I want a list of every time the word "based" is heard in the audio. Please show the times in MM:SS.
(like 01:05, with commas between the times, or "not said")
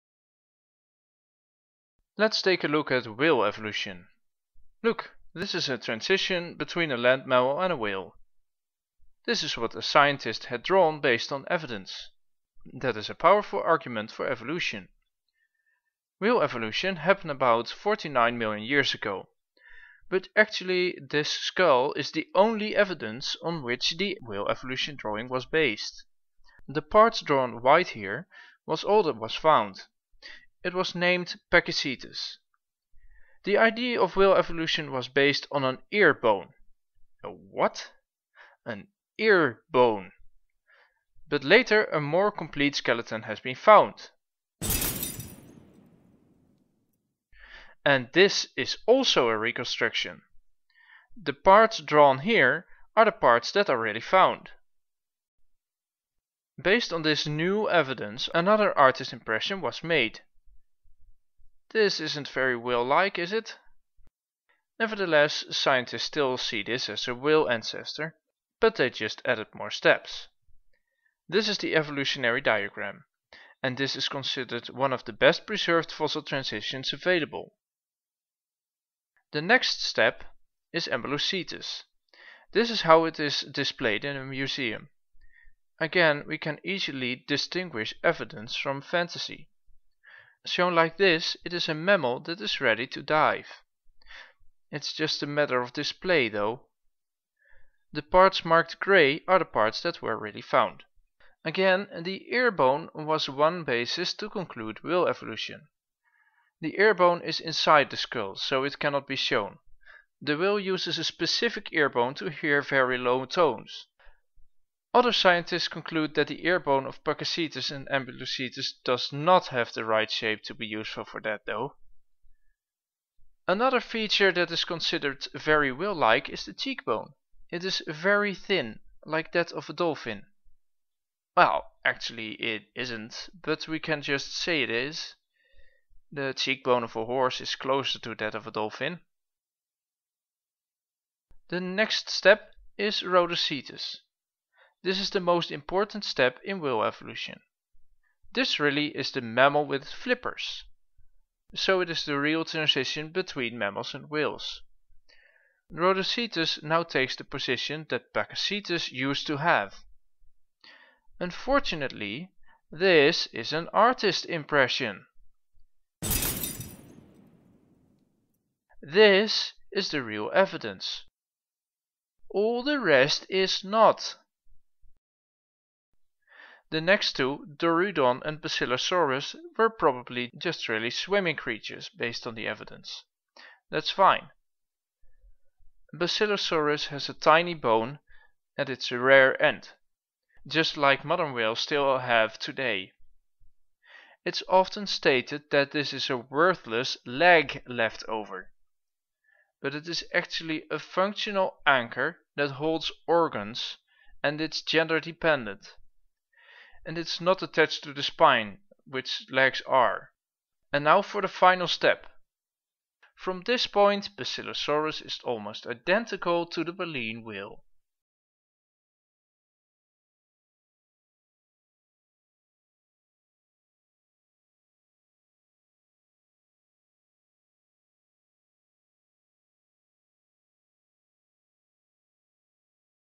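00:10, 00:25, 00:35, 00:56, 03:01.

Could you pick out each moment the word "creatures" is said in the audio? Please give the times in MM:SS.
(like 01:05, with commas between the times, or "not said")
03:01.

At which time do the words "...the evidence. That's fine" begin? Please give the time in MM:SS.
03:02.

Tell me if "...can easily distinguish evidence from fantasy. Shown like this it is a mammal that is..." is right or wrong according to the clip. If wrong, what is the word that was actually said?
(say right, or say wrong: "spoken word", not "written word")
right.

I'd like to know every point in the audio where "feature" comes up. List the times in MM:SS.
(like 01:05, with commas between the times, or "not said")
02:03.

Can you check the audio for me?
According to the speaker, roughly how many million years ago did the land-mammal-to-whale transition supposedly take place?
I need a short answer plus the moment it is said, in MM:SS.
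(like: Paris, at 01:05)
49 million years ago, at 00:17.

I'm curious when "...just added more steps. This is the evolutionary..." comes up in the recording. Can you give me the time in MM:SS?
01:08.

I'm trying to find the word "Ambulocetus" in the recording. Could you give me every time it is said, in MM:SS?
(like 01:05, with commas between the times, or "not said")
01:20, 01:57.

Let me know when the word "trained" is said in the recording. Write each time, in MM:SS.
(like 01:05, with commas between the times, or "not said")
not said.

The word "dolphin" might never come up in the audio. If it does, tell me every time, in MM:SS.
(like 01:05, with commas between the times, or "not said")
02:09, 02:18.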